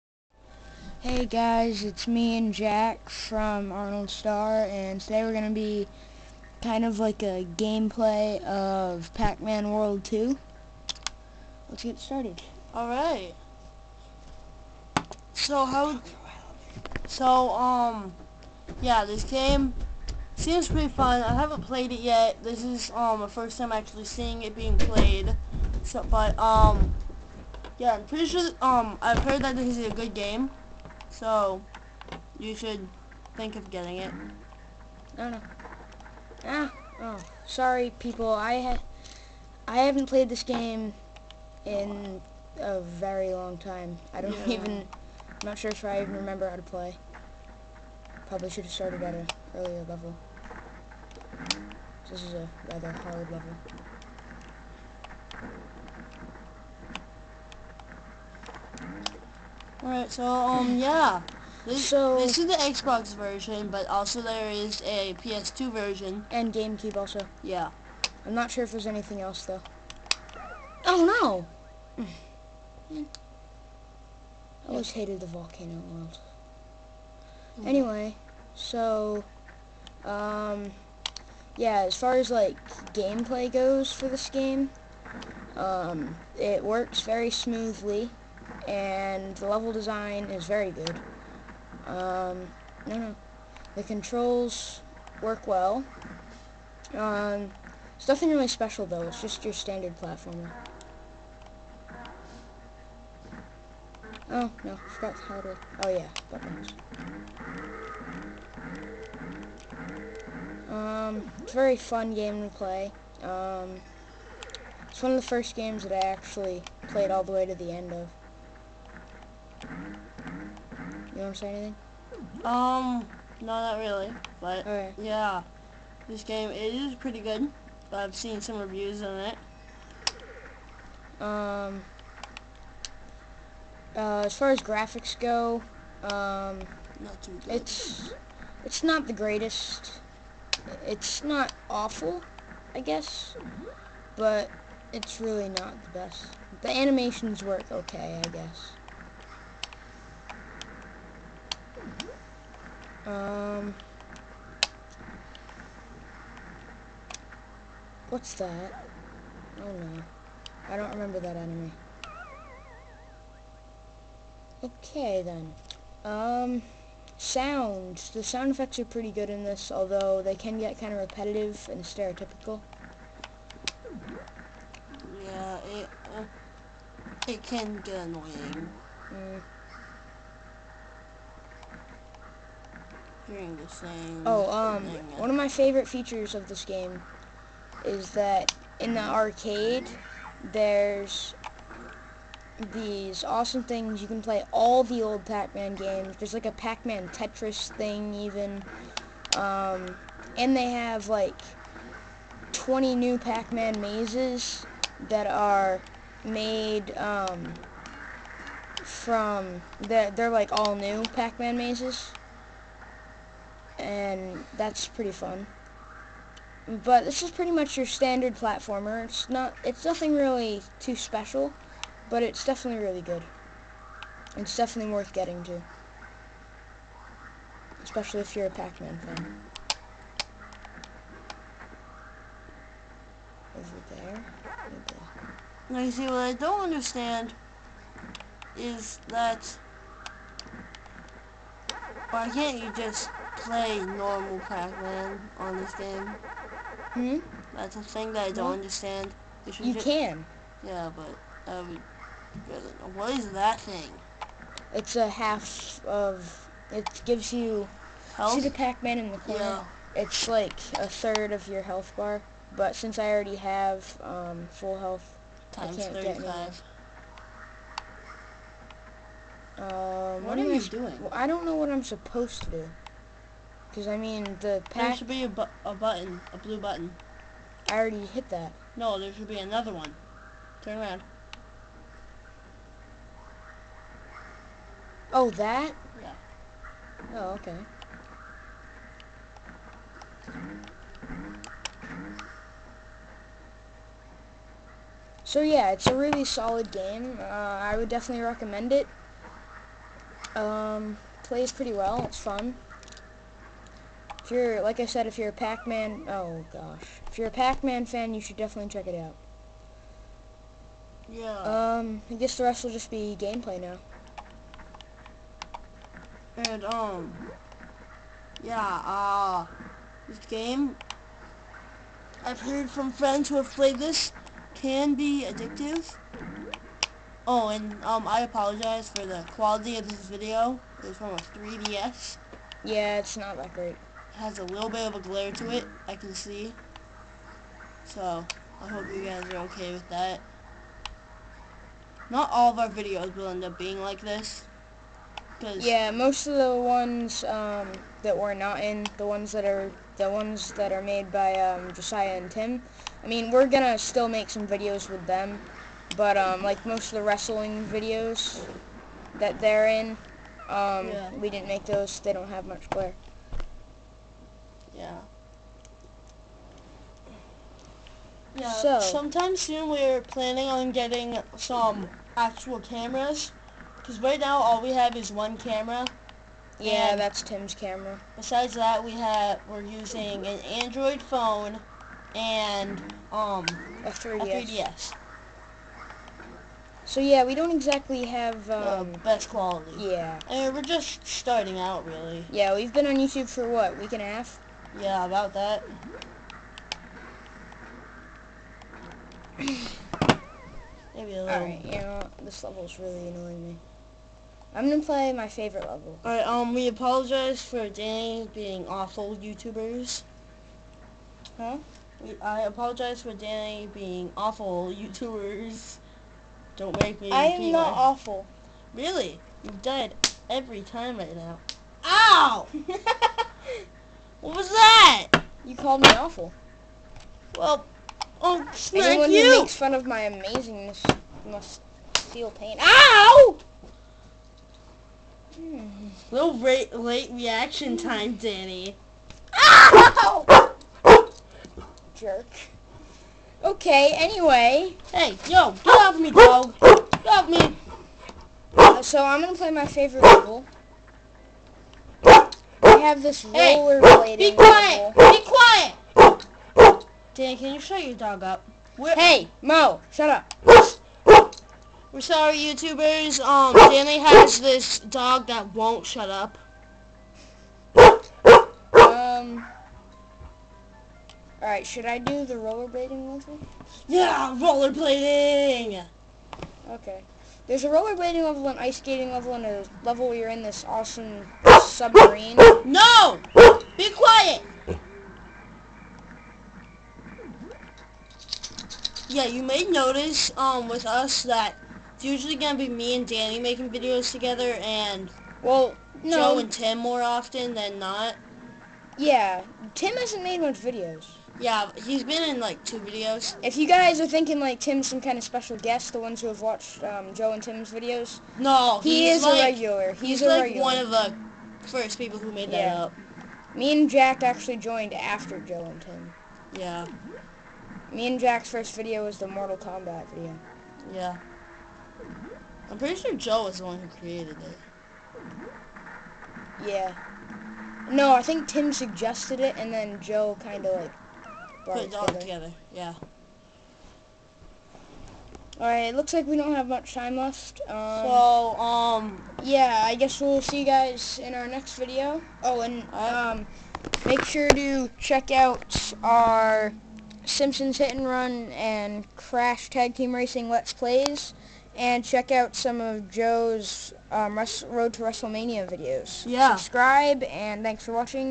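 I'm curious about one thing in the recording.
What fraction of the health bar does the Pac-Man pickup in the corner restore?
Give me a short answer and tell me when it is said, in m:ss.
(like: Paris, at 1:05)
a third, at 4:20.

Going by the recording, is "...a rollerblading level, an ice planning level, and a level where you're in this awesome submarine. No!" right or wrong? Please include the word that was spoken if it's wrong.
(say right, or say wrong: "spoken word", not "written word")
wrong: "skating", not "planning".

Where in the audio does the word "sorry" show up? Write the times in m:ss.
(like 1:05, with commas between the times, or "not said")
0:37, 7:42.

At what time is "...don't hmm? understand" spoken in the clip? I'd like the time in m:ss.
4:08.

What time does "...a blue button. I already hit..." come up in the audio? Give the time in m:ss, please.
4:36.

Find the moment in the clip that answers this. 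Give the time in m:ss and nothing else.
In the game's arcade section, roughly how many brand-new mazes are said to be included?
3:22.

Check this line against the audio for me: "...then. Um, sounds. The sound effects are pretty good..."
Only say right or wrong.
right.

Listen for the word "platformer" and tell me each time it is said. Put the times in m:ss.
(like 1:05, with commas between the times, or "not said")
1:39, 3:38.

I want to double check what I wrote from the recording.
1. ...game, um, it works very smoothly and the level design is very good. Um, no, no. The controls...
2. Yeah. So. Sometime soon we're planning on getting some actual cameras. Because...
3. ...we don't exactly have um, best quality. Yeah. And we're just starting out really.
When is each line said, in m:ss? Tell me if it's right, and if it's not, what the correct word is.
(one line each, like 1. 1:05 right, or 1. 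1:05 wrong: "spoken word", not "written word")
1. 1:24 right
2. 6:08 right
3. 6:27 right.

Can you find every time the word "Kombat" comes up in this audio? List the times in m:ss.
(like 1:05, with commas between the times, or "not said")
8:39.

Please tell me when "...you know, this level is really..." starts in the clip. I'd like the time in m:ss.
6:41.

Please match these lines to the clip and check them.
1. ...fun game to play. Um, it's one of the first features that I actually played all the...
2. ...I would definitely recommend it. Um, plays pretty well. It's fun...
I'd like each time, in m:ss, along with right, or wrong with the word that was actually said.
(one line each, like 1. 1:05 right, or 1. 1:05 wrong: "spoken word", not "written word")
1. 1:51 wrong: "games", not "features"
2. 4:57 right.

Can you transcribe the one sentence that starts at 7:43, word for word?
Um, Danny has this dog that won't shut up.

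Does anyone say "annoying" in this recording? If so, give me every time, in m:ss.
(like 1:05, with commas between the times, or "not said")
2:57, 6:43.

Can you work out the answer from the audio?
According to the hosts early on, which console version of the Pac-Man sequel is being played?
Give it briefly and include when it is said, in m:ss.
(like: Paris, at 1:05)
Xbox, at 1:02.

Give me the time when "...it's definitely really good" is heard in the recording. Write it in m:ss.
3:42.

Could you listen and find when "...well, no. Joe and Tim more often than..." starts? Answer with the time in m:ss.
8:15.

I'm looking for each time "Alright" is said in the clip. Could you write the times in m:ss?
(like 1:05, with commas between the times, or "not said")
0:12, 0:59, 6:41, 6:46, 8:55.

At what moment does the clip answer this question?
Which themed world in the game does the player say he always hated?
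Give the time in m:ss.
1:15.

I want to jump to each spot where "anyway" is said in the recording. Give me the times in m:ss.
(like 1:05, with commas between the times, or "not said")
1:17, 7:23.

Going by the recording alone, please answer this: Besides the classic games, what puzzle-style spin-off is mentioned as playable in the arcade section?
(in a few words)
Pac-Man Tetris.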